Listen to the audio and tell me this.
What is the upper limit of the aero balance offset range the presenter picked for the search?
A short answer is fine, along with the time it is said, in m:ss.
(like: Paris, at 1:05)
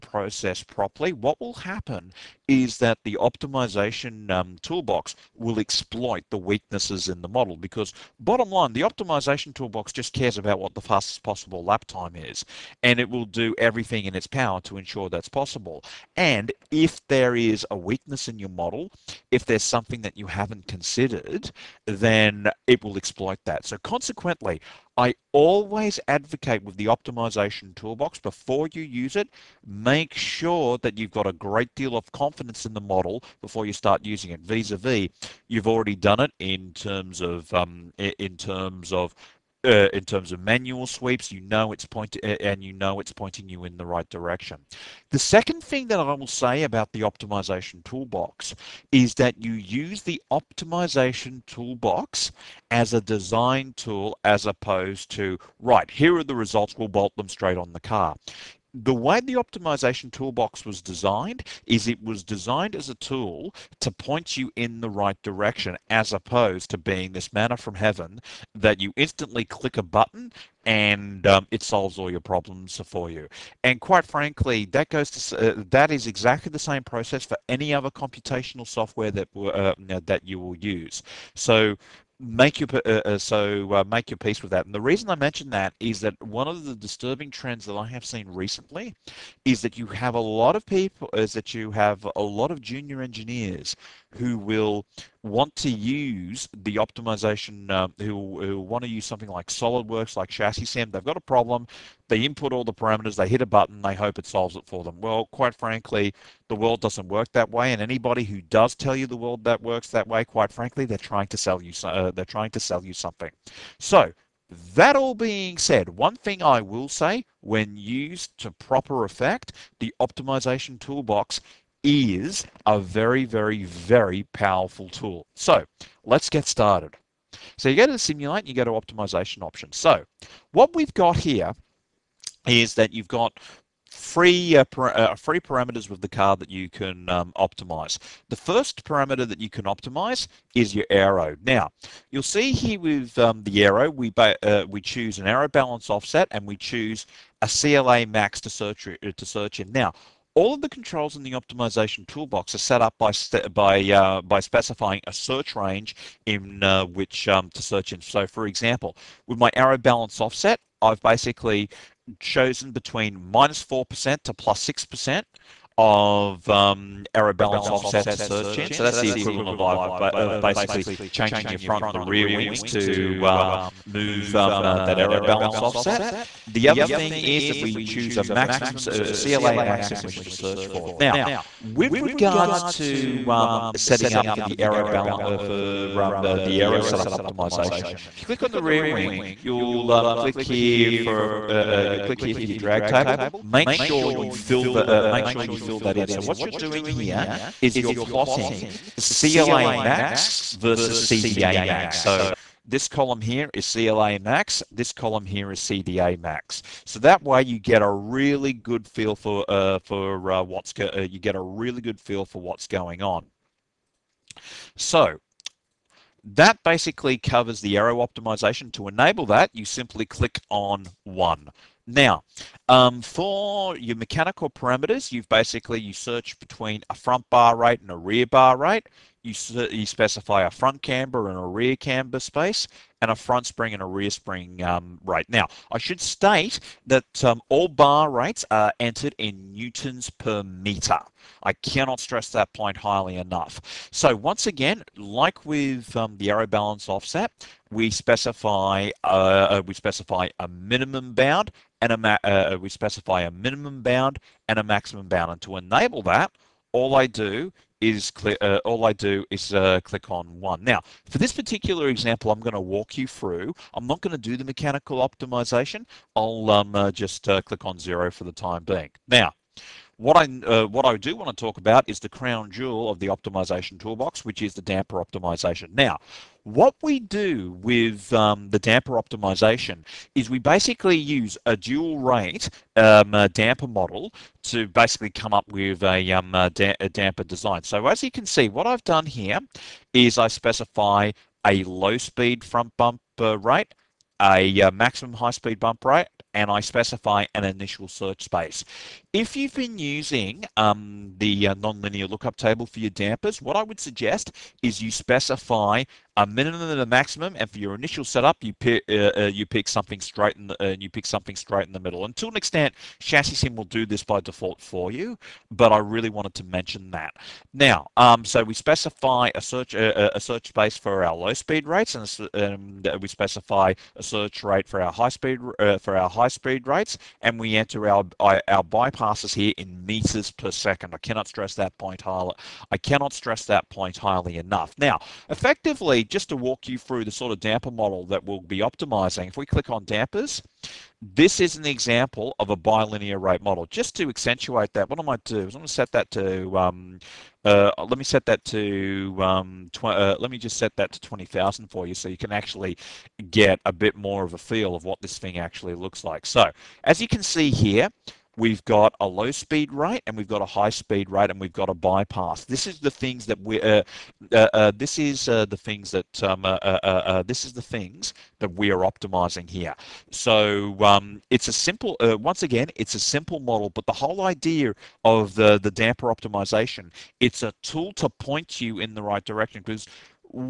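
+6 percent, at 2:44.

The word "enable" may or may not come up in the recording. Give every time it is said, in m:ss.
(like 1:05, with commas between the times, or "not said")
3:38, 4:15.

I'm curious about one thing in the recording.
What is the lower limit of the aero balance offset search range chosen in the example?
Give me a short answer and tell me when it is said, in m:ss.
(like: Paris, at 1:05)
-4 percent, at 2:43.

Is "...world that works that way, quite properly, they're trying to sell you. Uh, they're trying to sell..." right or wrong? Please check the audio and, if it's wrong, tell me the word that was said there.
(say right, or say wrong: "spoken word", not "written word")
wrong: "frankly", not "properly".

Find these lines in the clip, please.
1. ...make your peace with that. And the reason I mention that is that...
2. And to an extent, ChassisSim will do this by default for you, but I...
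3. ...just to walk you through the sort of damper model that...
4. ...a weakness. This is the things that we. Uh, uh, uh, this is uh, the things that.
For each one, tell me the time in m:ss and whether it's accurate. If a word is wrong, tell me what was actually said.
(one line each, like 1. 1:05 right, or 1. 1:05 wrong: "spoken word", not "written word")
1. 1:23 right
2. 5:12 right
3. 5:36 right
4. 6:01 wrong: "bypass", not "weakness".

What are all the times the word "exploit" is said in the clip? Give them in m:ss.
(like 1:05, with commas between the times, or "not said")
0:05, 0:22.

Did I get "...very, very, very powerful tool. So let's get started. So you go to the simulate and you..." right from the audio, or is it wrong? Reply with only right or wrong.
right.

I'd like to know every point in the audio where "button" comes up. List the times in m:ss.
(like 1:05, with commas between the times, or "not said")
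1:09, 1:43.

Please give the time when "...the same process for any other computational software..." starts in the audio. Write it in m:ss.
1:16.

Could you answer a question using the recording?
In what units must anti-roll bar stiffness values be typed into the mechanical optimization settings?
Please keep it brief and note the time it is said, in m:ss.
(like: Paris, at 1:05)
newtons per meter, at 3:59.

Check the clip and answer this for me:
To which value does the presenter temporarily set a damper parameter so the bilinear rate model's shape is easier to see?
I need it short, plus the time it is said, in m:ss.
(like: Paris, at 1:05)
20,000, at 5:50.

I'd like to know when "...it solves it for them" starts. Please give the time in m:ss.
1:44.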